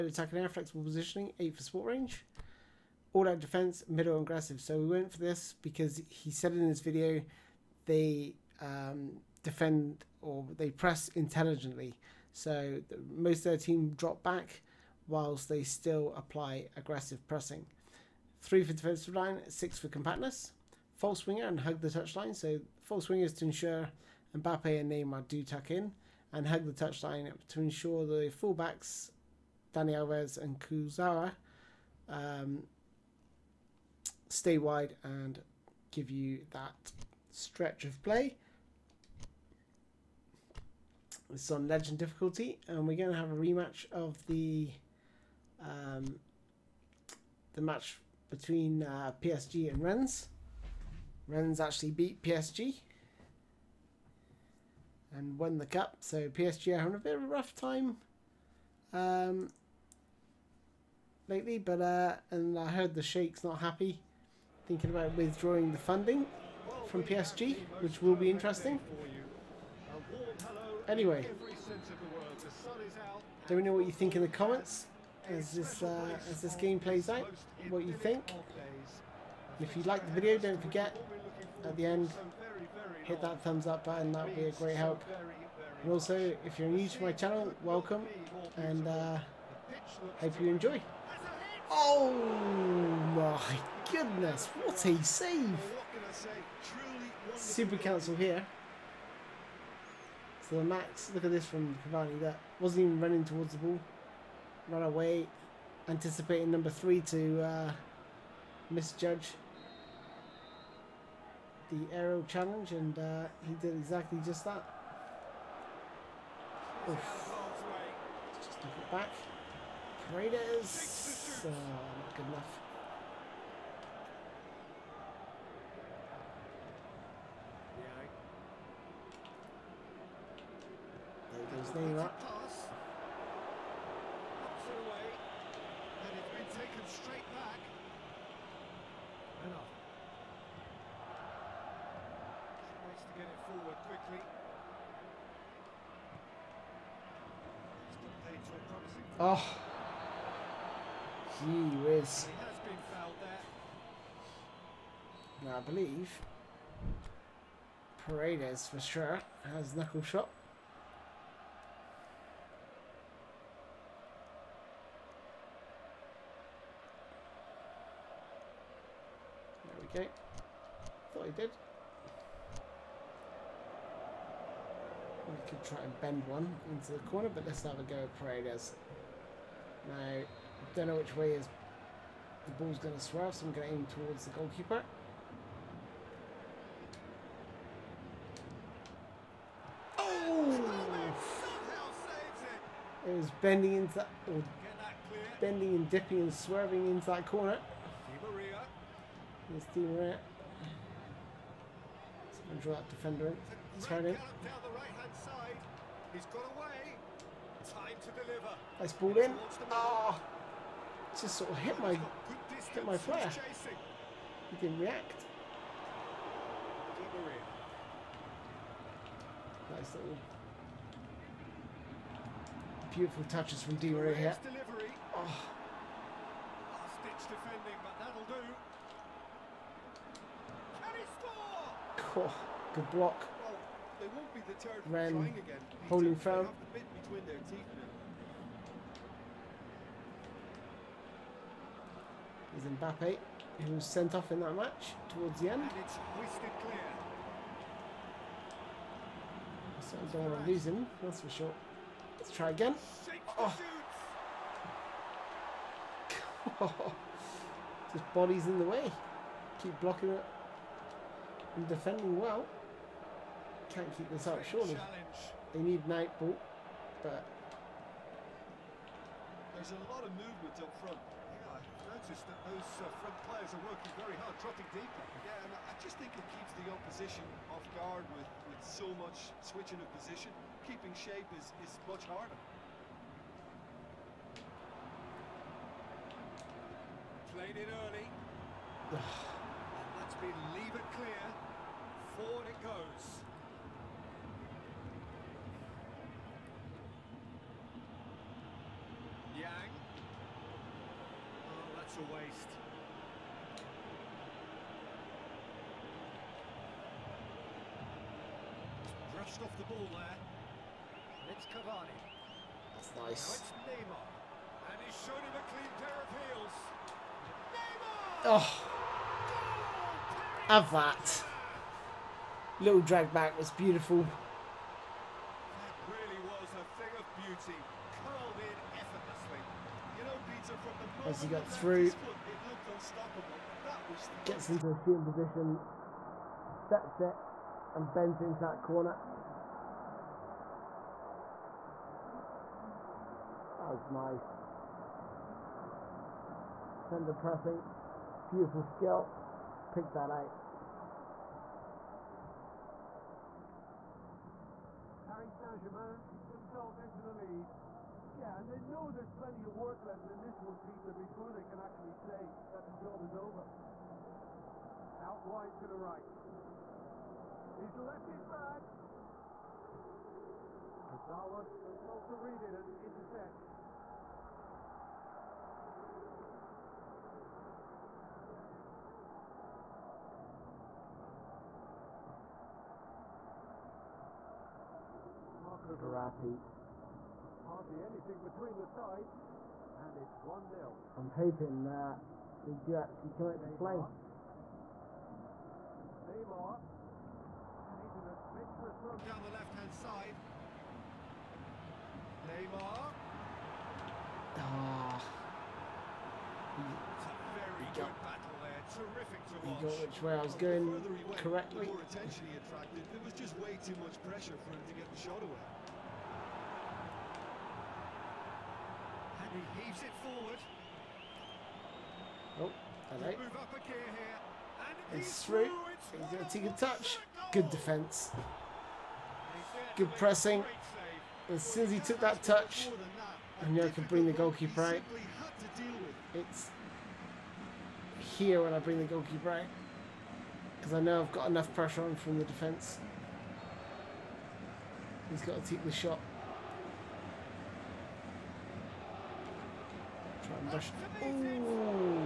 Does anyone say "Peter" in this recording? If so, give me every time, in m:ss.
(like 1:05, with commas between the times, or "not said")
5:30, 6:00.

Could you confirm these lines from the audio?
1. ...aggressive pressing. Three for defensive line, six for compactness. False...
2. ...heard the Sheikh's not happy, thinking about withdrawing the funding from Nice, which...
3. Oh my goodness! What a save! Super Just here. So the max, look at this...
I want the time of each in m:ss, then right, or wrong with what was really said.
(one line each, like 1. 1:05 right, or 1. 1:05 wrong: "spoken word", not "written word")
1. 0:16 right
2. 1:02 wrong: "PSG", not "Nice"
3. 1:31 wrong: "Council", not "Just".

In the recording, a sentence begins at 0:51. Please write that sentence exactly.
Rennes actually beat PSG and won the cup.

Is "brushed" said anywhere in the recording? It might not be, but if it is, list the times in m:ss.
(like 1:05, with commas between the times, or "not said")
5:09.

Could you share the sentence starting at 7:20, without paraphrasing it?
Because I know I've got enough pressure on from the defence.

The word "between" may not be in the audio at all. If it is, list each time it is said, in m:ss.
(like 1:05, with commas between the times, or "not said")
0:48, 6:28.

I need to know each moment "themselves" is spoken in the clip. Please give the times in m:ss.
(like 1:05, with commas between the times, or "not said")
5:56.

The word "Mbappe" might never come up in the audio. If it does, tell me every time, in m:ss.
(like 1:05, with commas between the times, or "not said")
0:24, 4:02.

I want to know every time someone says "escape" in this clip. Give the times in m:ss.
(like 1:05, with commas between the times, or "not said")
not said.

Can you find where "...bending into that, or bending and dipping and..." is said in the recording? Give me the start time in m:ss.
3:13.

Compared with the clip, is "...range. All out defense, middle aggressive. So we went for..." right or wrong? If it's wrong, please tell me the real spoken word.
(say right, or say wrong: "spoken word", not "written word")
right.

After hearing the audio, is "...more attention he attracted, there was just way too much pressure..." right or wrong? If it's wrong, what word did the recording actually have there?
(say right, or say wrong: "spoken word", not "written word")
right.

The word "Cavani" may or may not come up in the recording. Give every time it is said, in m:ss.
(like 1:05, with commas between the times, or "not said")
1:41, 5:11.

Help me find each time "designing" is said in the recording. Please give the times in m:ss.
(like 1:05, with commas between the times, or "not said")
not said.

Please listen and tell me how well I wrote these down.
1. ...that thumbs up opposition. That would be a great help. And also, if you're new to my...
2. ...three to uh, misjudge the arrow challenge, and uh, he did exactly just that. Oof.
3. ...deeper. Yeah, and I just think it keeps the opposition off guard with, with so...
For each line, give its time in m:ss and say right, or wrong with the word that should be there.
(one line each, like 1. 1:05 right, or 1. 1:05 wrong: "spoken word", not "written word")
1. 1:23 wrong: "button", not "opposition"
2. 1:46 right
3. 4:34 right.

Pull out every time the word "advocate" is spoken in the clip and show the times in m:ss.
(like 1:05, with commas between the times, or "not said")
not said.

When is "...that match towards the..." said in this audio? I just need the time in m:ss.
4:04.